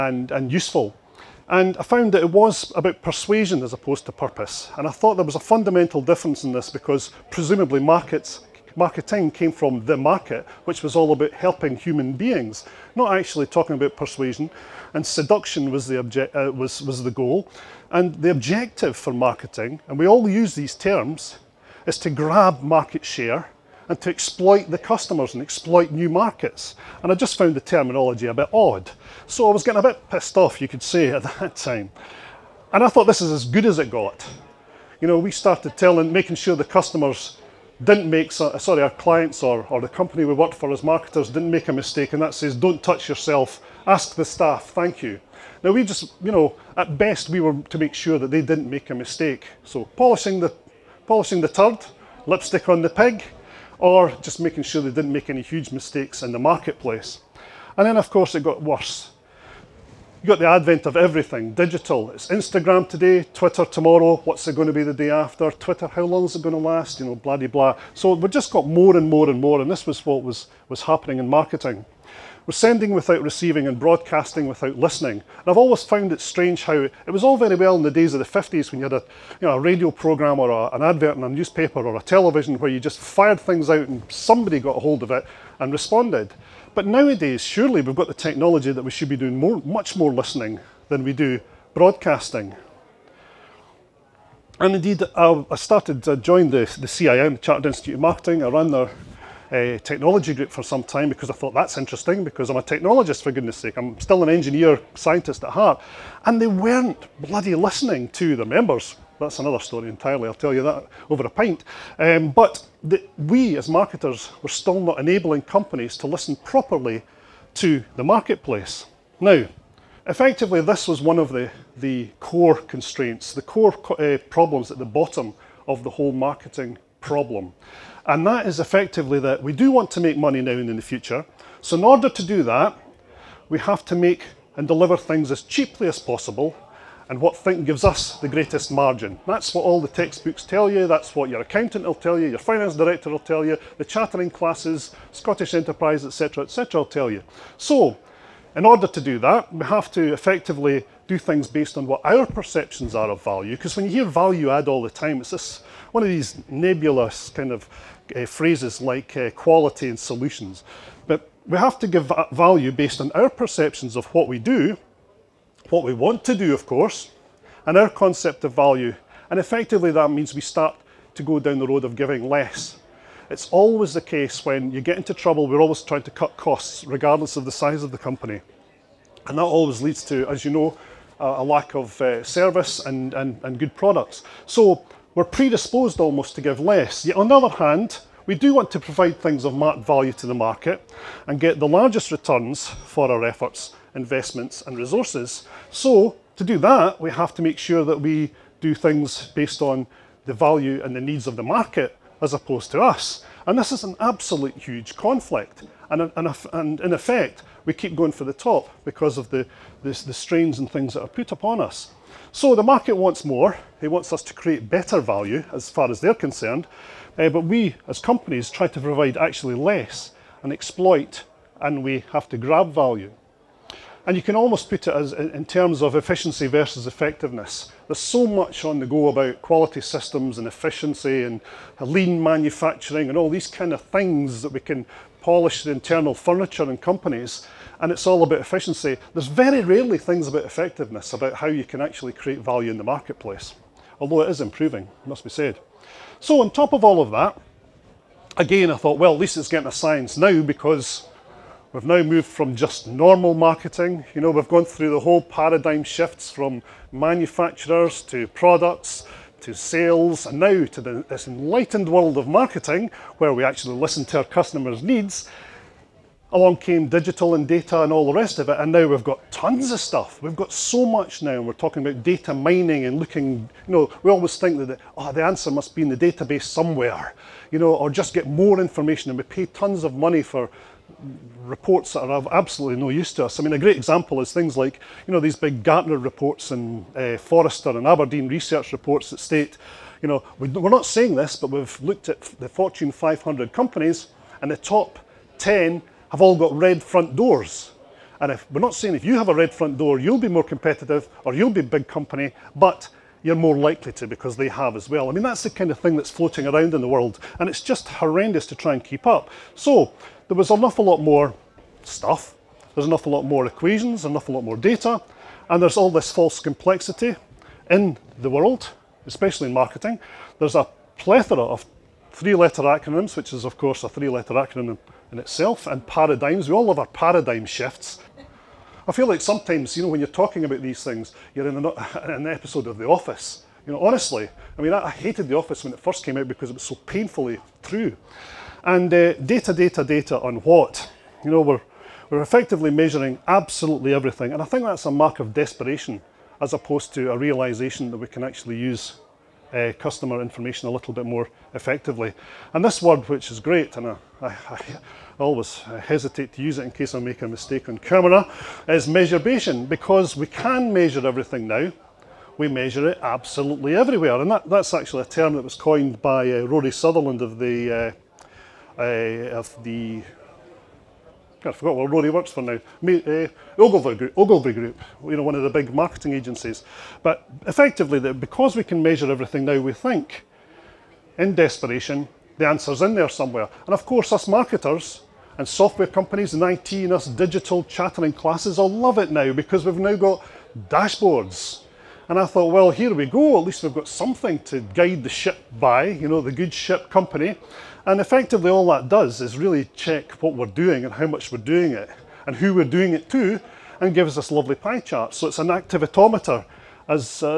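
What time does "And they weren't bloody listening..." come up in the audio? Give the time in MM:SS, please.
01:46.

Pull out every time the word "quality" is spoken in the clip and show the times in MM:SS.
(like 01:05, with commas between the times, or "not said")
02:39, 03:49.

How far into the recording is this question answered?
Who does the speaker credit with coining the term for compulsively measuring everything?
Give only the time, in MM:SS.
06:06.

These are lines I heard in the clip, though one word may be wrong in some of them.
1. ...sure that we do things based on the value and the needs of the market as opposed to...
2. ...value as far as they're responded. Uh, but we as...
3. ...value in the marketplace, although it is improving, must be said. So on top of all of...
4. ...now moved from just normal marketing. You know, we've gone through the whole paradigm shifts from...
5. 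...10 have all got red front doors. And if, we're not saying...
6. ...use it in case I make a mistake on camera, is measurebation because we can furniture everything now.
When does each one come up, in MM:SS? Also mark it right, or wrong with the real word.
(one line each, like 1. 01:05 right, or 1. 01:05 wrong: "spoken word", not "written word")
1. 03:17 right
2. 03:34 wrong: "concerned", not "responded"
3. 04:02 right
4. 04:11 right
5. 04:55 right
6. 05:56 wrong: "measure", not "furniture".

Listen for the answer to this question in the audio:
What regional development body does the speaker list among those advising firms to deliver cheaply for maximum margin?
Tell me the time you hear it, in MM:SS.
02:25.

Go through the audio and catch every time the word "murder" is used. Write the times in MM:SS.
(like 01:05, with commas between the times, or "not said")
not said.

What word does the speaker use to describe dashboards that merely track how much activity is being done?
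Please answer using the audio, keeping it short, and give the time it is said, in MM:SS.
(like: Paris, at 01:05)
activitometer, at 06:45.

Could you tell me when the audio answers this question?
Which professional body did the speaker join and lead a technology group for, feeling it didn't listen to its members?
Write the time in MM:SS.
01:37.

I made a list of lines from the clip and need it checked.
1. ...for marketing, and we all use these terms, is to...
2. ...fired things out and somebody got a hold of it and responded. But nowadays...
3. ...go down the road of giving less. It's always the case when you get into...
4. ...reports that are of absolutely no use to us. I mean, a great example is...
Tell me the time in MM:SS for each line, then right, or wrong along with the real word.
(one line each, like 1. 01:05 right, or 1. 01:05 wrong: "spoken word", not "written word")
1. 00:18 right
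2. 01:22 right
3. 02:51 right
4. 04:41 right.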